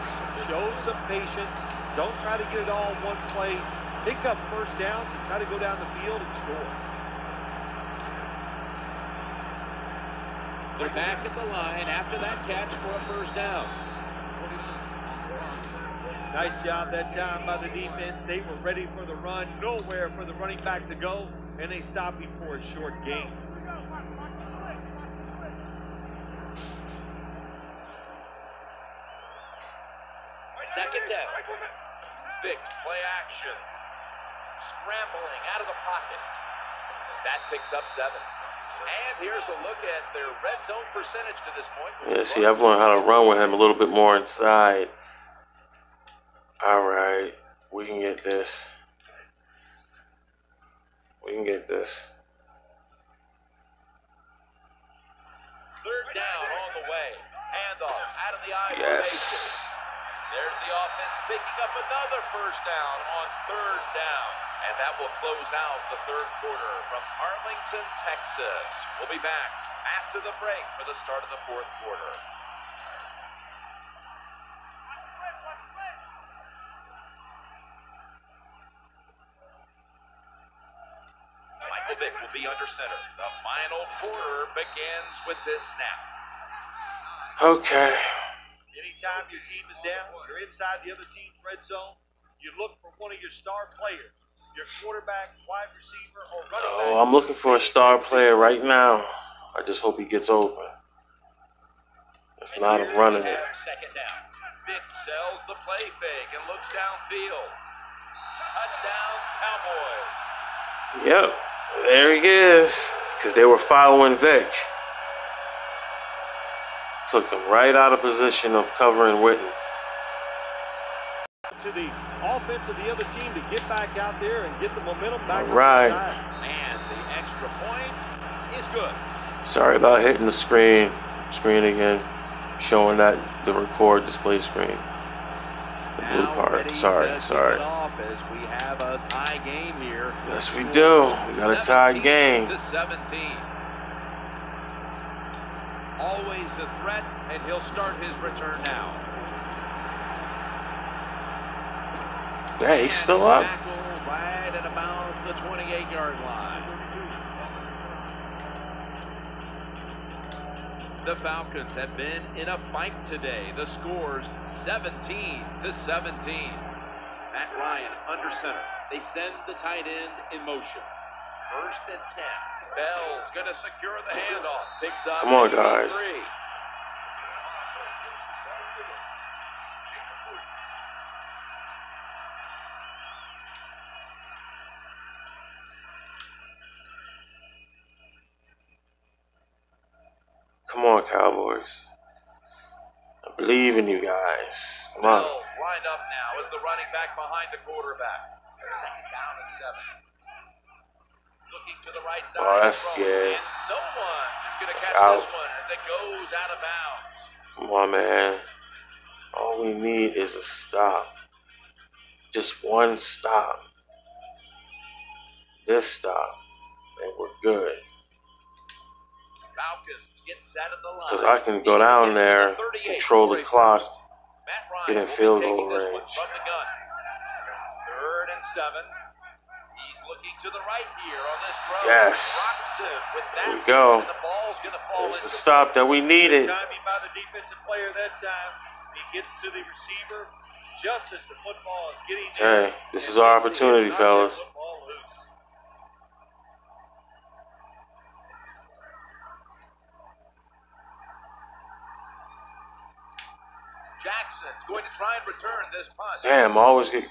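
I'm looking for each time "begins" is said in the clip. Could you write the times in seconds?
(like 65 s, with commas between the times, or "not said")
84 s.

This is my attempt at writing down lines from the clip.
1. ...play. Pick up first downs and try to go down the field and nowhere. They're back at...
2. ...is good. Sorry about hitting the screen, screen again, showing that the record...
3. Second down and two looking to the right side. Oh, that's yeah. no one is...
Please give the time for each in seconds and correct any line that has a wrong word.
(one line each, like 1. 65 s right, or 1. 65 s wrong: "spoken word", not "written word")
1. 3 s wrong: "score", not "nowhere"
2. 128 s right
3. 198 s wrong: "seven", not "two".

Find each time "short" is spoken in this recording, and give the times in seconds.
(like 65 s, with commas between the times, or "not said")
22 s.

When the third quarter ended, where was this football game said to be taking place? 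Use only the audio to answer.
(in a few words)
Arlington, Texas.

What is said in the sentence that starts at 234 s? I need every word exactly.
The There's the stop that we needed.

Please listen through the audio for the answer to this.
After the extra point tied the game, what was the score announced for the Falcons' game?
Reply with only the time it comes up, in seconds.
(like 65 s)
164 s.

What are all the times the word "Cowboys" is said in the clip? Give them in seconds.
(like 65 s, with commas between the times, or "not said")
109 s, 191 s.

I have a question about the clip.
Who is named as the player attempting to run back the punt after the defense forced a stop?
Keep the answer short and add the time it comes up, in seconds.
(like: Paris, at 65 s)
Jackson, at 254 s.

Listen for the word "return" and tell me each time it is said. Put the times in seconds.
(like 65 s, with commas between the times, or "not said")
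148 s, 255 s.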